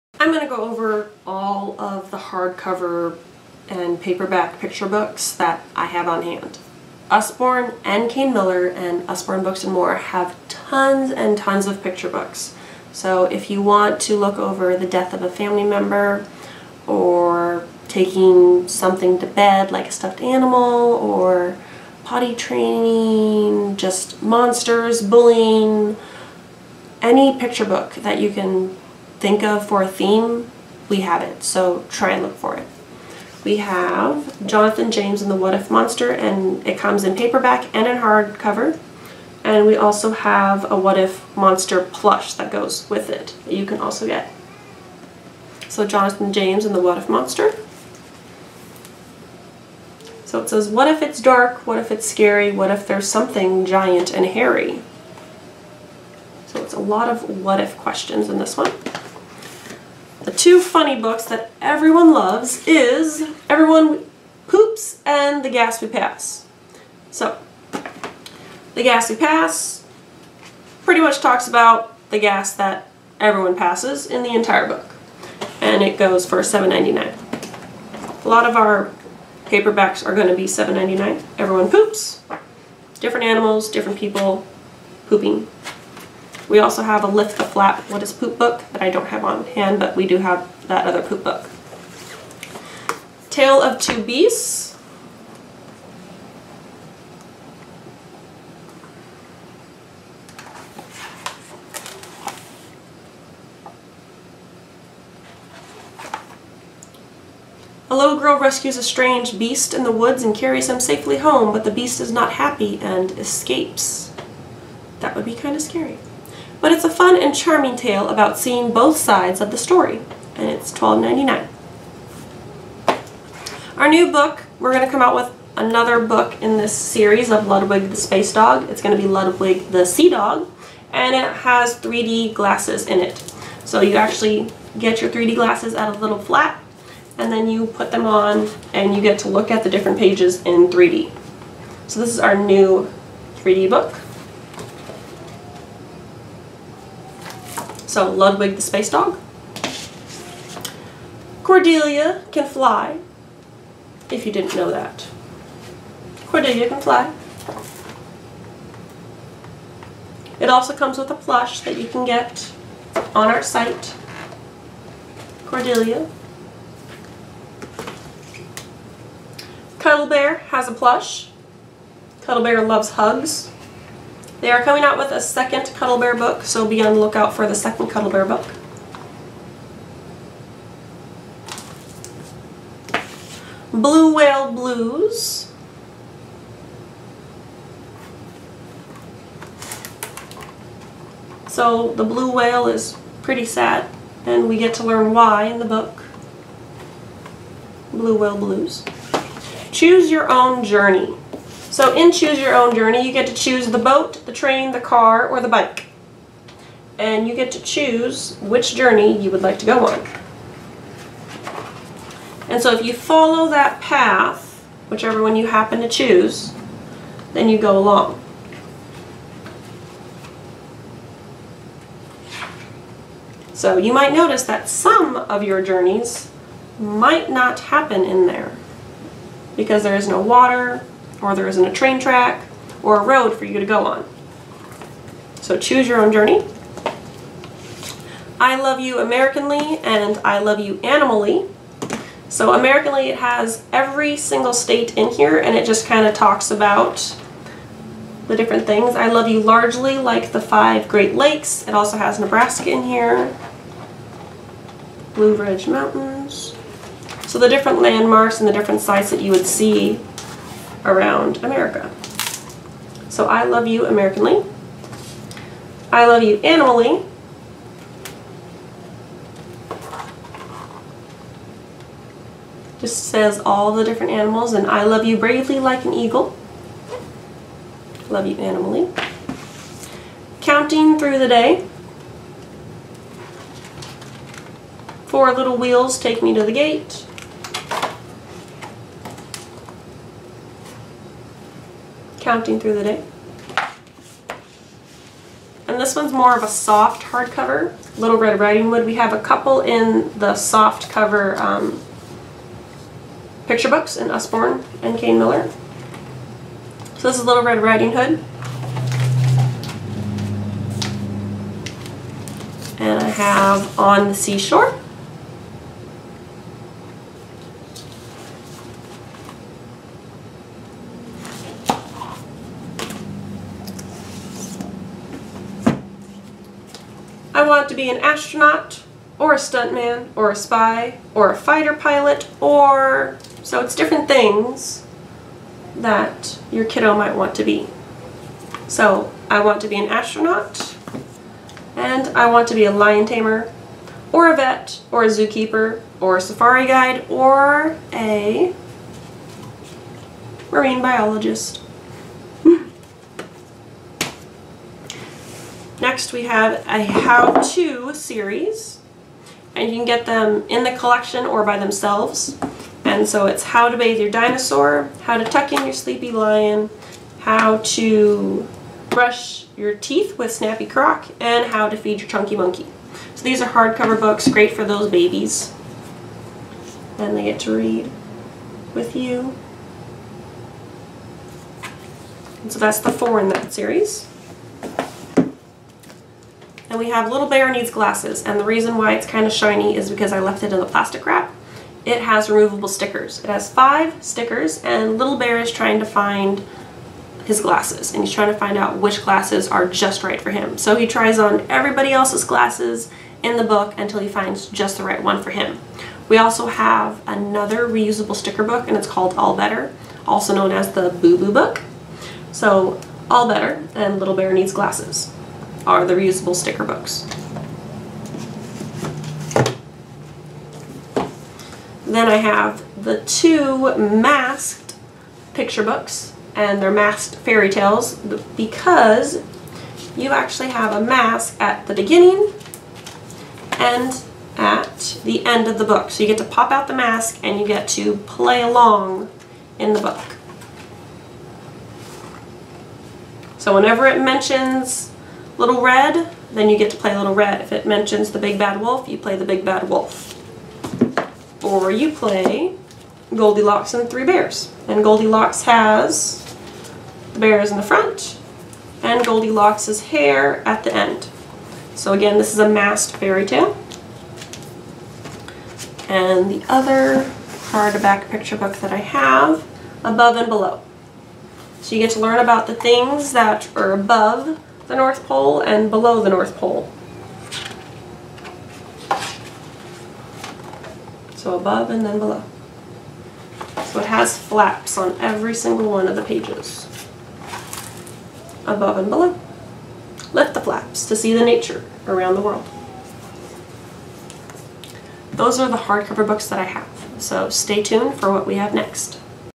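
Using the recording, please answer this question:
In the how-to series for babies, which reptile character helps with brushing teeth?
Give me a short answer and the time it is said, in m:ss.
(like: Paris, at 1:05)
Snappy Croc, at 6:10.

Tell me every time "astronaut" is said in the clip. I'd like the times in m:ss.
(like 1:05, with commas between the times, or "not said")
5:28, 5:39.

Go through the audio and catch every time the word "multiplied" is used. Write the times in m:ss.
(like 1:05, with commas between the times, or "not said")
not said.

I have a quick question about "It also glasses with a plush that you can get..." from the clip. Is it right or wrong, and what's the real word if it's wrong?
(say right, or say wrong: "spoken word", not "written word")
wrong: "comes", not "glasses".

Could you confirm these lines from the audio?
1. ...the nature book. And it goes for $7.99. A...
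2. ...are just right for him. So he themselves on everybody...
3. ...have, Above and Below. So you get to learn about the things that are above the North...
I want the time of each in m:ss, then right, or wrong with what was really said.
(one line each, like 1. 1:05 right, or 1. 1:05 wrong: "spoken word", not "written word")
1. 1:14 wrong: "entire", not "nature"
2. 6:39 wrong: "tries", not "themselves"
3. 7:48 right.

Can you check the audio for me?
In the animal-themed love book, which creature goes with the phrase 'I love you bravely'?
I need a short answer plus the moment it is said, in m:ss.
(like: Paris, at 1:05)
an eagle, at 4:35.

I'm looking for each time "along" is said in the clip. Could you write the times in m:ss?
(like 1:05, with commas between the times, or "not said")
3:37, 7:18.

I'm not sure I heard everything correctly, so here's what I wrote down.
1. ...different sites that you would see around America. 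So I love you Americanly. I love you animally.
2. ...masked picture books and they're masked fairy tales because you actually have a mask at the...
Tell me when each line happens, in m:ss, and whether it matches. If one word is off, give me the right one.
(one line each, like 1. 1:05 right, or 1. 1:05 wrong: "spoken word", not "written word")
1. 4:18 right
2. 7:03 right.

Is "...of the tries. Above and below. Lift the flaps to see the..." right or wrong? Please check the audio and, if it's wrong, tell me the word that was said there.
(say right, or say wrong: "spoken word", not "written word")
wrong: "pages", not "tries".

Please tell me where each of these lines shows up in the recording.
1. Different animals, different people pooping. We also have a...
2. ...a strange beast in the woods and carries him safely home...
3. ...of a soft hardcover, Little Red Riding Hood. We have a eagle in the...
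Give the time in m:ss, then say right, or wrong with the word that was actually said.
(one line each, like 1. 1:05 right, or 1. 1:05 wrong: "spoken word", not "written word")
1. 1:22 right
2. 1:48 right
3. 4:56 wrong: "couple", not "eagle".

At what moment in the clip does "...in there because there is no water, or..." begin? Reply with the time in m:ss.
3:48.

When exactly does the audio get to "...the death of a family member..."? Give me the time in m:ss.
0:14.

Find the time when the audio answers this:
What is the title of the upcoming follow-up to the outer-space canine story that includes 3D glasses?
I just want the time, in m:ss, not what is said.
2:09.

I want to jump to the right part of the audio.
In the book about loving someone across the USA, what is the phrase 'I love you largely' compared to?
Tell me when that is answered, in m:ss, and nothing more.
4:10.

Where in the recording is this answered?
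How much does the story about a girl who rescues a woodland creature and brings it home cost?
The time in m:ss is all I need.
2:00.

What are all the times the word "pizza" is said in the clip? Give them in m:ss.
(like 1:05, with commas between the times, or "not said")
not said.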